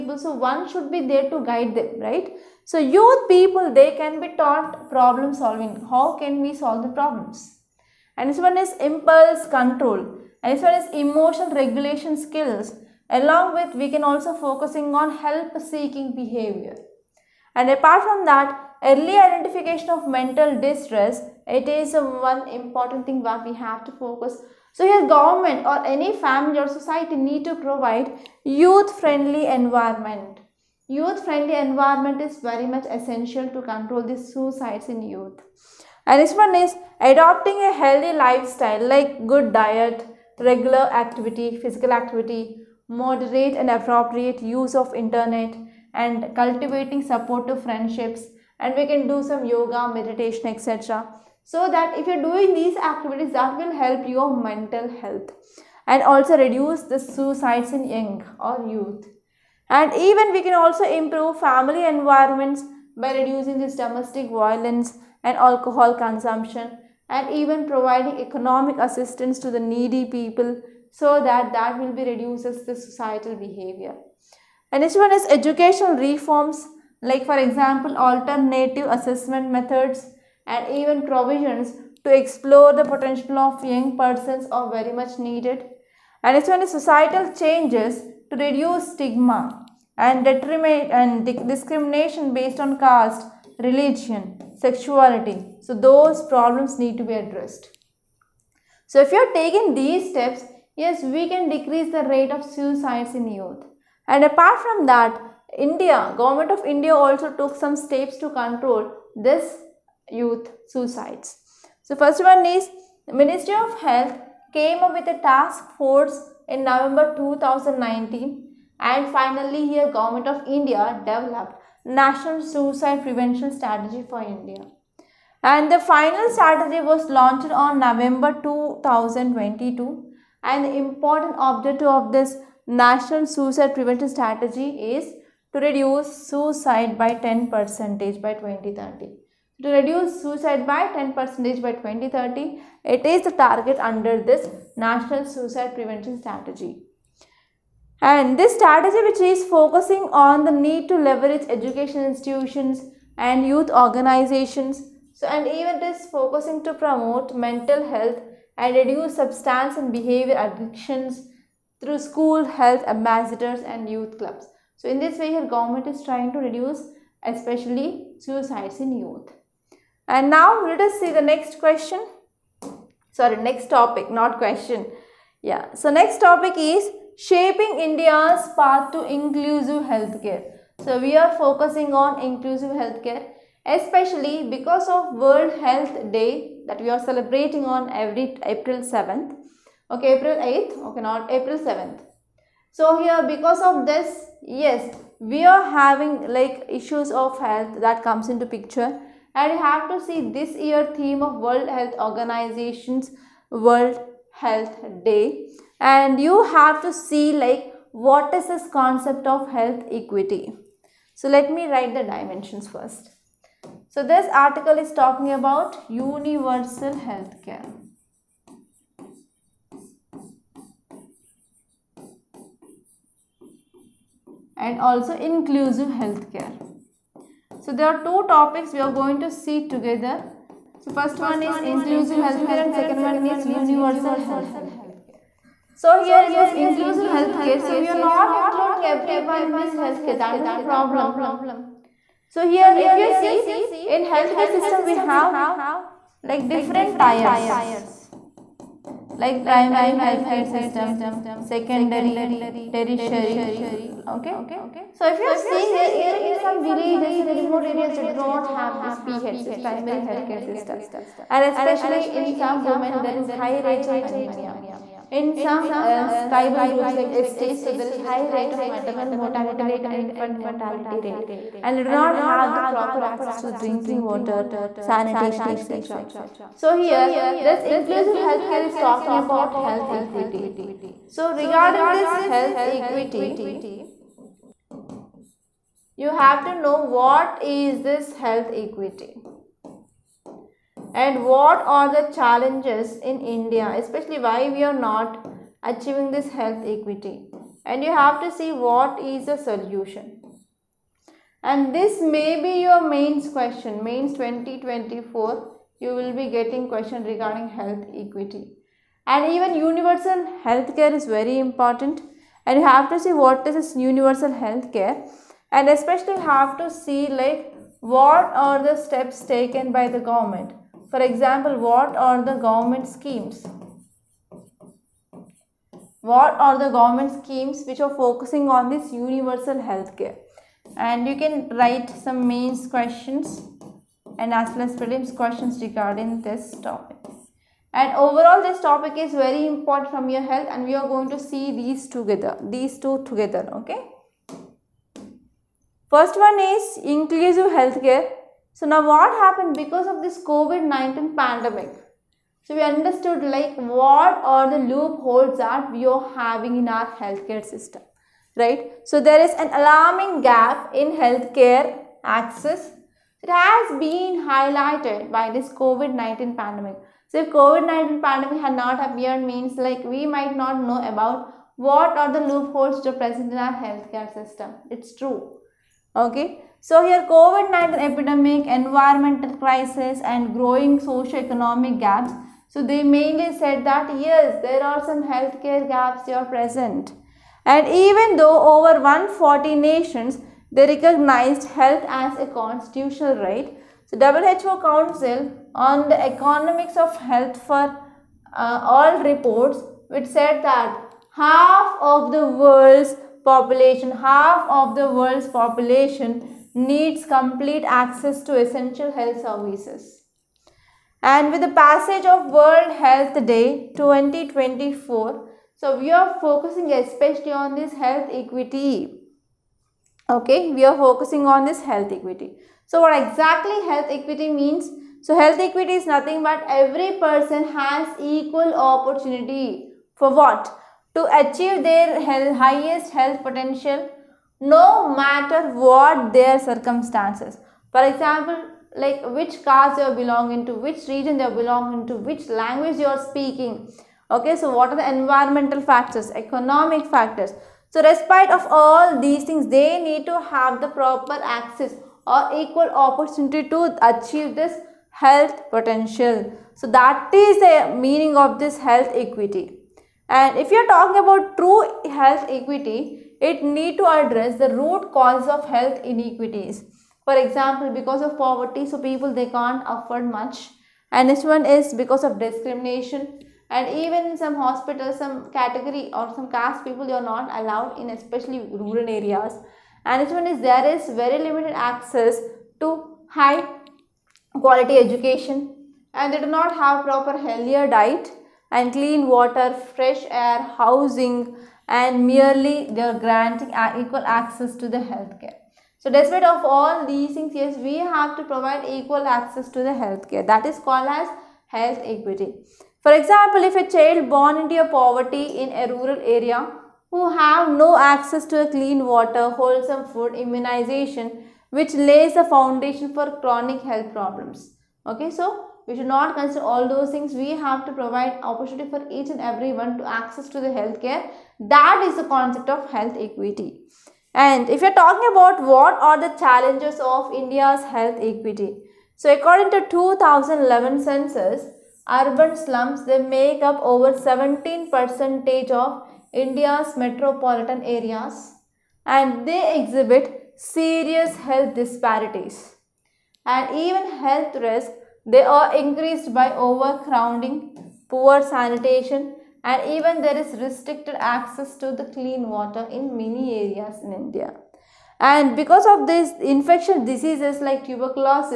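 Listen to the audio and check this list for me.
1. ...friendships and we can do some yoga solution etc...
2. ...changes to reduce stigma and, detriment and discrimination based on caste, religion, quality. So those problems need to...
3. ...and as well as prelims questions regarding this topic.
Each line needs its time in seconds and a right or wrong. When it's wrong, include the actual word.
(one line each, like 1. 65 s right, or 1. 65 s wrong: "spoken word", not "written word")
1. 47 s wrong: "meditation", not "solution"
2. 87 s wrong: "sexuality", not "quality"
3. 334 s right.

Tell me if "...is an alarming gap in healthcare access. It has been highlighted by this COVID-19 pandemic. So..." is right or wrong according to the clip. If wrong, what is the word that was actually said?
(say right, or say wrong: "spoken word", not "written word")
right.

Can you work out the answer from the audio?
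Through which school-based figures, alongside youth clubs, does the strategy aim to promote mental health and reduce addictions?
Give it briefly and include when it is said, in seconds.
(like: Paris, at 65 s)
School health ambassadors, at 161 s.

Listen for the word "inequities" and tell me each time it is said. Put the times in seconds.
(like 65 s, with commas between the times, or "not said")
465 s.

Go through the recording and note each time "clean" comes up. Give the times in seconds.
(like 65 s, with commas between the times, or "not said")
488 s, 508 s, 551 s.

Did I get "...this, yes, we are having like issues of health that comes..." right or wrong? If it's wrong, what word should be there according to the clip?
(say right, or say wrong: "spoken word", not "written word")
right.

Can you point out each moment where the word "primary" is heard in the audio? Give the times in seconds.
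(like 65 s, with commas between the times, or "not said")
249 s, 259 s.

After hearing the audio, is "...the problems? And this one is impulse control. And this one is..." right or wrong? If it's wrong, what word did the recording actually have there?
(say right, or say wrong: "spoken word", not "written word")
right.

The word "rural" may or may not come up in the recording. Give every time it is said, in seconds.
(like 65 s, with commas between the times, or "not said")
478 s, 505 s.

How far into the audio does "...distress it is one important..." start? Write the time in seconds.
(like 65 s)
20 s.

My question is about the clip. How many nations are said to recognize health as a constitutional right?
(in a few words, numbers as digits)
Over 140.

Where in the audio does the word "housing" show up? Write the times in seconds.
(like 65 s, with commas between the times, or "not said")
490 s.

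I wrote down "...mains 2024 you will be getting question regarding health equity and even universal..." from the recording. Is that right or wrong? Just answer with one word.
right.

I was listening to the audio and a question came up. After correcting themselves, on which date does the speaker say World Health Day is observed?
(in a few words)
April 8.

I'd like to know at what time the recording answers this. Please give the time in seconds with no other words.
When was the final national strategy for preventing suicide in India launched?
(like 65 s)
127 s.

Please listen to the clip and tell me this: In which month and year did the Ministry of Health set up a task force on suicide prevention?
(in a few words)
November 2019.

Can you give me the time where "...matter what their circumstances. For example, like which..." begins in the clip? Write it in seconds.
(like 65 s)
434 s.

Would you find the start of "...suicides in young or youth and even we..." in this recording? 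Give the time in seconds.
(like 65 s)
56 s.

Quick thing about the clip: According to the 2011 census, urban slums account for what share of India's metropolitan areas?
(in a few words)
Over 17 percent.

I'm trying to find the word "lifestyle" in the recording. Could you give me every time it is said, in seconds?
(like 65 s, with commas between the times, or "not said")
38 s.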